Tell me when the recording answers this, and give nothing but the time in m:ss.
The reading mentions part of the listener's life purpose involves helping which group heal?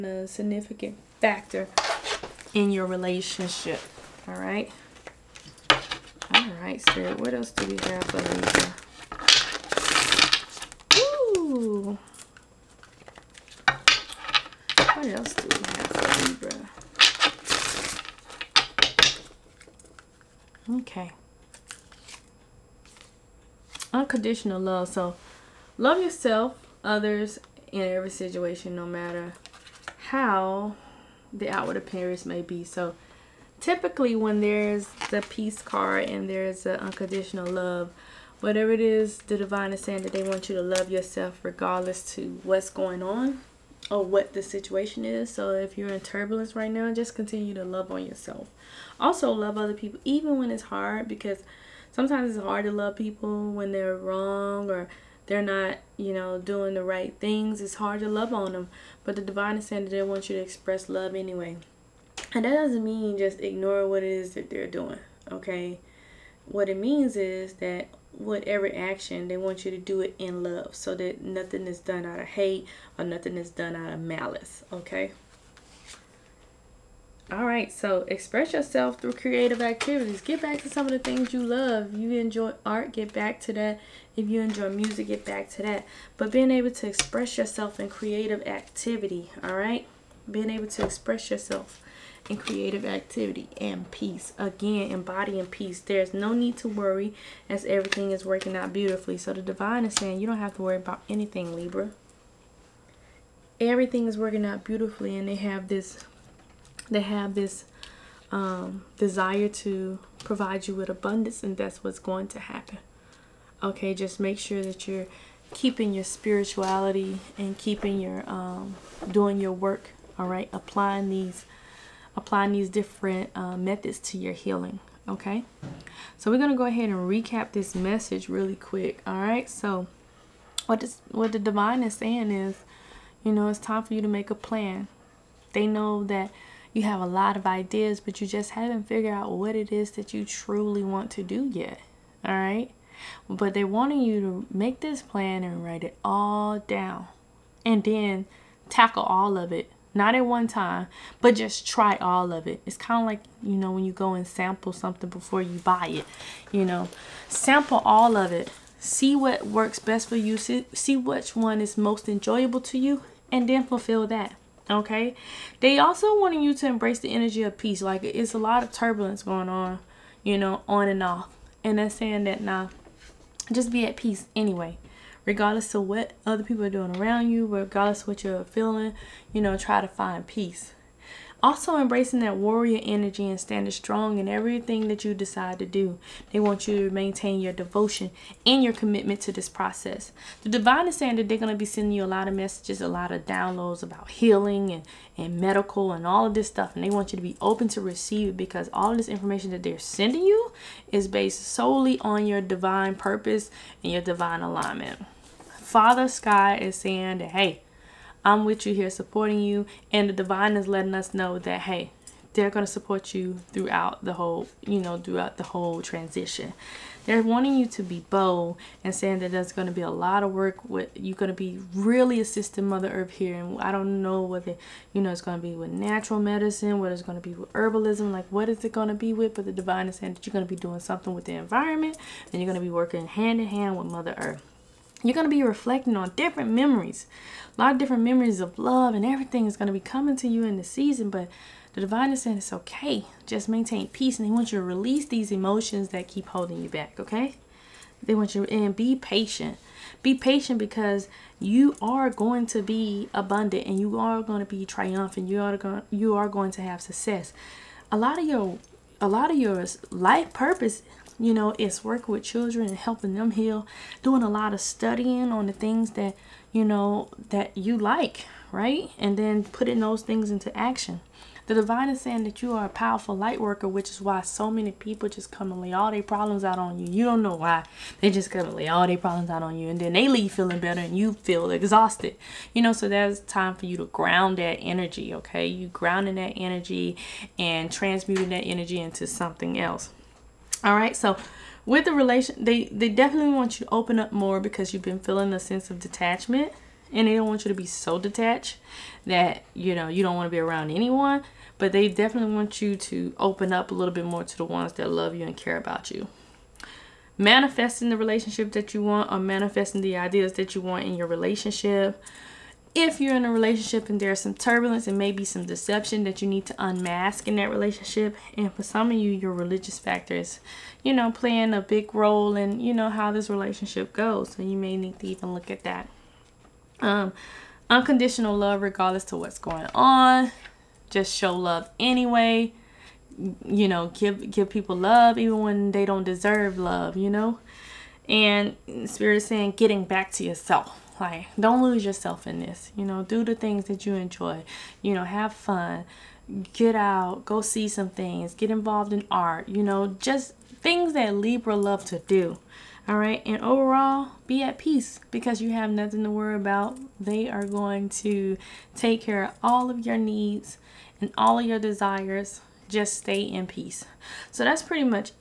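4:22.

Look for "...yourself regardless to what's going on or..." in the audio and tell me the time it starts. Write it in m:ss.
0:40.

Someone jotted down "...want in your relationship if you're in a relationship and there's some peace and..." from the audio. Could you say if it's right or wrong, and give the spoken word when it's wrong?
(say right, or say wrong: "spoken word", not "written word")
wrong: "turbulence", not "peace".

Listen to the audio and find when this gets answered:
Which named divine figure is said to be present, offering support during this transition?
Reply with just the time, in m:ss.
3:25.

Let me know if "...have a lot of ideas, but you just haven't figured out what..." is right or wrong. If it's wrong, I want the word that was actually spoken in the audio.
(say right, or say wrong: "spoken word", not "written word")
right.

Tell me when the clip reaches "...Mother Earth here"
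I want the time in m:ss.
3:42.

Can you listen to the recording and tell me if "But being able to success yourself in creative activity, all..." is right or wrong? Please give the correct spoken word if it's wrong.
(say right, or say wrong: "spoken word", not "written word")
wrong: "express", not "success".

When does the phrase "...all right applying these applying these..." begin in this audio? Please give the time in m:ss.
2:00.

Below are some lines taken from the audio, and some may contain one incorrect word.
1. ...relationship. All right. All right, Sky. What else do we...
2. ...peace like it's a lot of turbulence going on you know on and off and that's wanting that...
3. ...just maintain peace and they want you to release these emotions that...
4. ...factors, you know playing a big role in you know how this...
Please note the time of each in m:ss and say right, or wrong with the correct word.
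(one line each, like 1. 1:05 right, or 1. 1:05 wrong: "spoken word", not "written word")
1. 0:02 wrong: "Spirit", not "Sky"
2. 2:47 wrong: "saying", not "wanting"
3. 4:03 right
4. 5:19 right.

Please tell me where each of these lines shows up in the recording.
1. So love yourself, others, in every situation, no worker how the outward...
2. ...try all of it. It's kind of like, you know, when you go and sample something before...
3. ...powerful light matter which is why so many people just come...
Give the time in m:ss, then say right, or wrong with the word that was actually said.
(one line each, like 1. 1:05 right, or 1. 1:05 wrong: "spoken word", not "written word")
1. 0:24 wrong: "matter", not "worker"
2. 2:31 right
3. 4:32 wrong: "worker", not "matter".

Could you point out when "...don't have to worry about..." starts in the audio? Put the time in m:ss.
1:40.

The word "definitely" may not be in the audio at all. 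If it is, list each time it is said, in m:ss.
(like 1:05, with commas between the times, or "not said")
4:52, 5:01.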